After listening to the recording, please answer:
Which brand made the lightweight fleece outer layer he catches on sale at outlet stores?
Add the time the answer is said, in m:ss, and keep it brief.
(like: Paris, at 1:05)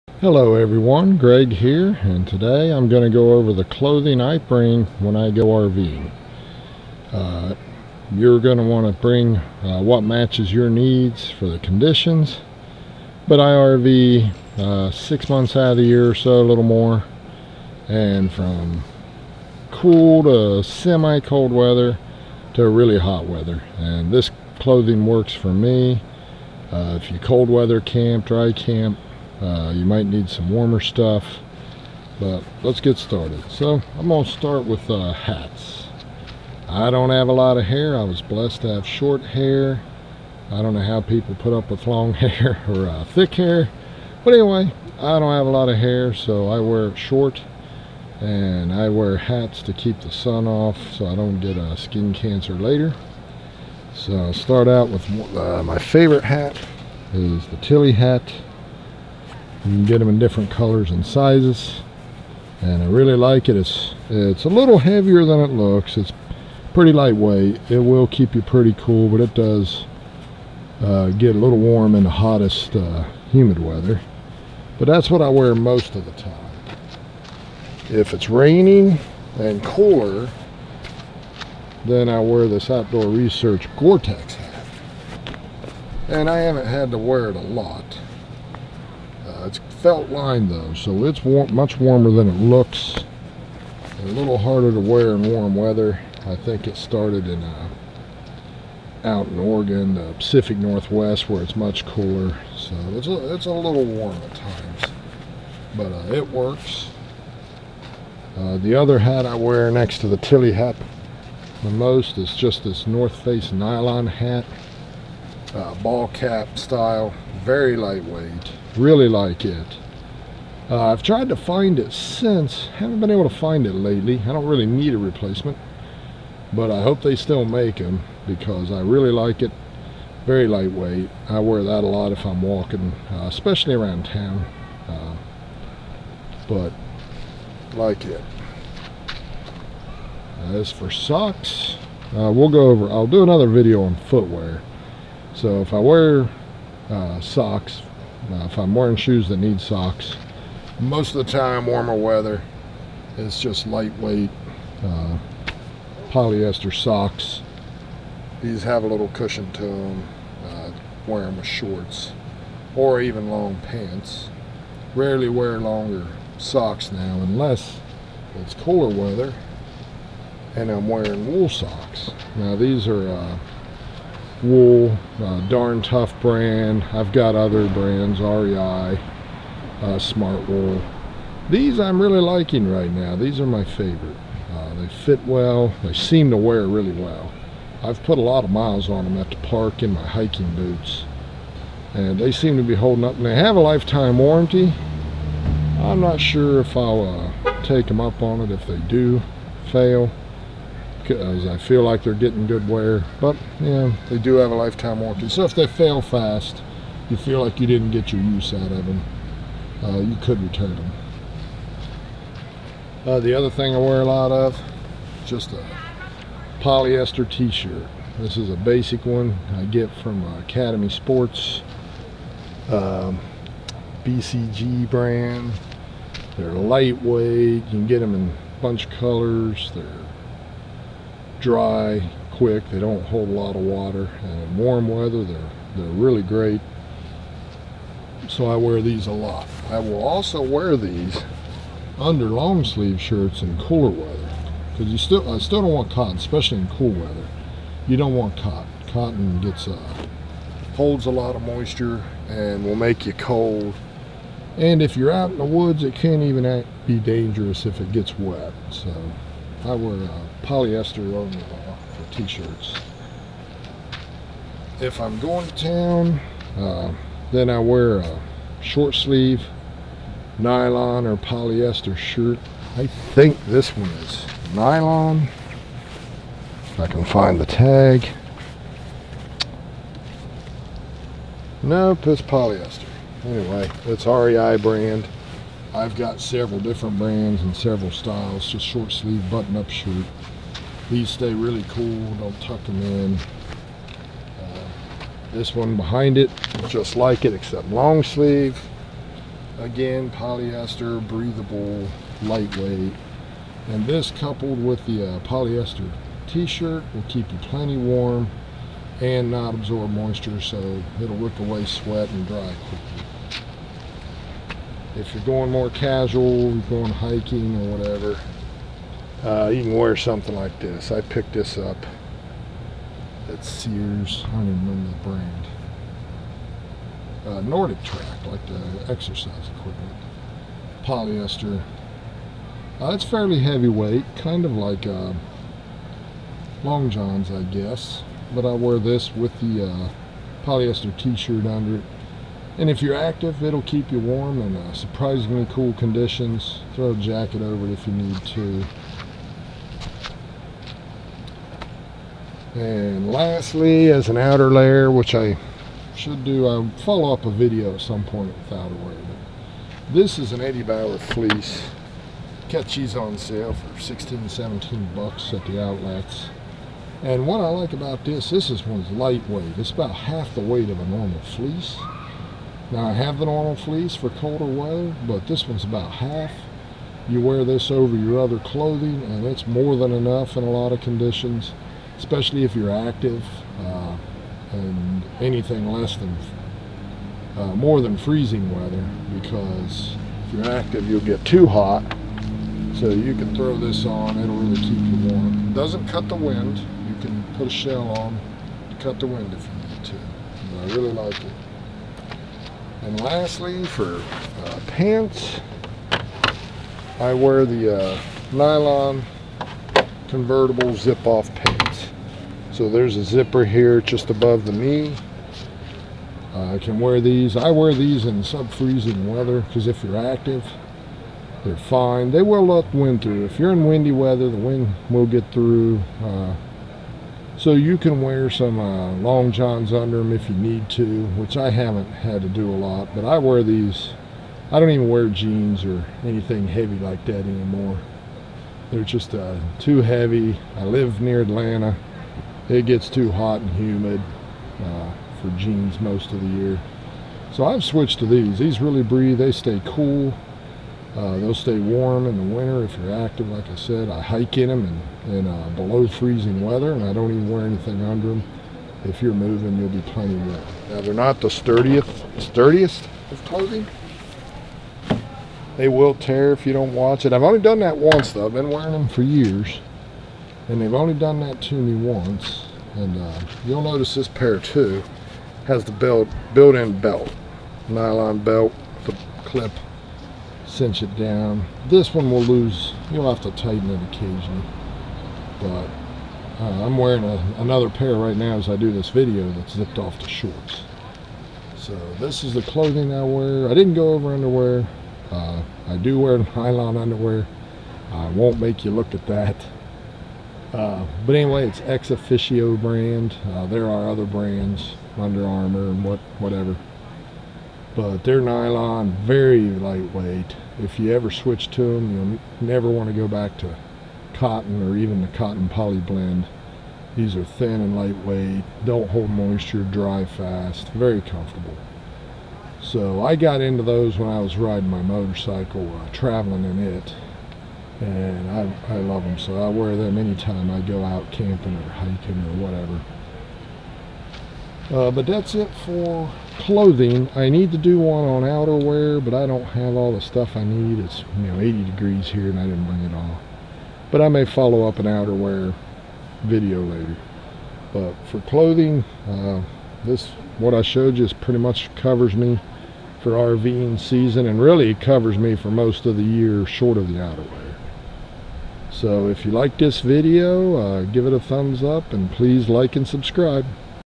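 Eddie Bauer, at 6:00.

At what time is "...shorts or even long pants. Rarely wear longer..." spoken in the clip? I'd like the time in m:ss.
2:41.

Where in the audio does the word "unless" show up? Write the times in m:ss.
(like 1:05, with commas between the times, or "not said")
2:47.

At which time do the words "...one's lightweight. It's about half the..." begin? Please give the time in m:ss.
6:08.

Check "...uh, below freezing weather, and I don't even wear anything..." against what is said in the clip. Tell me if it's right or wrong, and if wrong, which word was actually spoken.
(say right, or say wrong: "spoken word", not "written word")
right.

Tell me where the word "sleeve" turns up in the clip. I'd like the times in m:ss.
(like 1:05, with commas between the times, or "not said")
4:02, 4:28, 4:48, 4:58.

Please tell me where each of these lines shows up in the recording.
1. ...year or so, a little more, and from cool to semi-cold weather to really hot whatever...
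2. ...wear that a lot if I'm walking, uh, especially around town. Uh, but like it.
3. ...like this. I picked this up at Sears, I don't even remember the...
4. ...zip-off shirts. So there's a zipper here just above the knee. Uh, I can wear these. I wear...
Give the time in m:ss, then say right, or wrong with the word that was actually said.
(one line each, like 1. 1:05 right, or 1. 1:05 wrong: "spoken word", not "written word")
1. 0:15 wrong: "weather", not "whatever"
2. 2:11 right
3. 5:20 right
4. 6:50 wrong: "pants", not "shirts".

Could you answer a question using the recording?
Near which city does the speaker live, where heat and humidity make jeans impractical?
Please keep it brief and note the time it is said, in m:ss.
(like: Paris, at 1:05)
Atlanta, at 7:21.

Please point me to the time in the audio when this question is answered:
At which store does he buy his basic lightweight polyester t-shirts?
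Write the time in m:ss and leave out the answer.
3:40.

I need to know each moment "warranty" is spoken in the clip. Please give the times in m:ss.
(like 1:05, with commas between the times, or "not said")
3:14, 3:24.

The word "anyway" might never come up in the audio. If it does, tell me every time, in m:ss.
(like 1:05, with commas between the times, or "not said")
0:44, 4:43, 8:21.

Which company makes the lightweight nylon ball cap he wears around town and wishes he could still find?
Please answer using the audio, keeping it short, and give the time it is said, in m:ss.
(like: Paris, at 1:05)
North Face, at 1:52.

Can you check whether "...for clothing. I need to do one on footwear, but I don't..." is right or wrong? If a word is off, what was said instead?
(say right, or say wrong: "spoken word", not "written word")
wrong: "outerwear", not "footwear".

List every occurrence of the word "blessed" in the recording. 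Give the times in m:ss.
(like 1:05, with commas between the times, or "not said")
0:38.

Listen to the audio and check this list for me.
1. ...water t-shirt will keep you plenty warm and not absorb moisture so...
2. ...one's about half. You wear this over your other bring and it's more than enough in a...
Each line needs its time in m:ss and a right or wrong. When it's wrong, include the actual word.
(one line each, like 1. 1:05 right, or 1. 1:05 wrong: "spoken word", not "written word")
1. 5:05 wrong: "polyester", not "water"
2. 6:15 wrong: "clothing", not "bring".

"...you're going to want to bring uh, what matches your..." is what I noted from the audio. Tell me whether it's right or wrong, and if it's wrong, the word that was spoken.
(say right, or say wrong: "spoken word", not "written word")
right.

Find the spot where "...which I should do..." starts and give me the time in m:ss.
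5:54.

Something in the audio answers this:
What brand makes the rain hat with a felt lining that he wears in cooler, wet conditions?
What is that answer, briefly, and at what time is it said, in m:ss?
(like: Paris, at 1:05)
Outdoor Research, at 1:22.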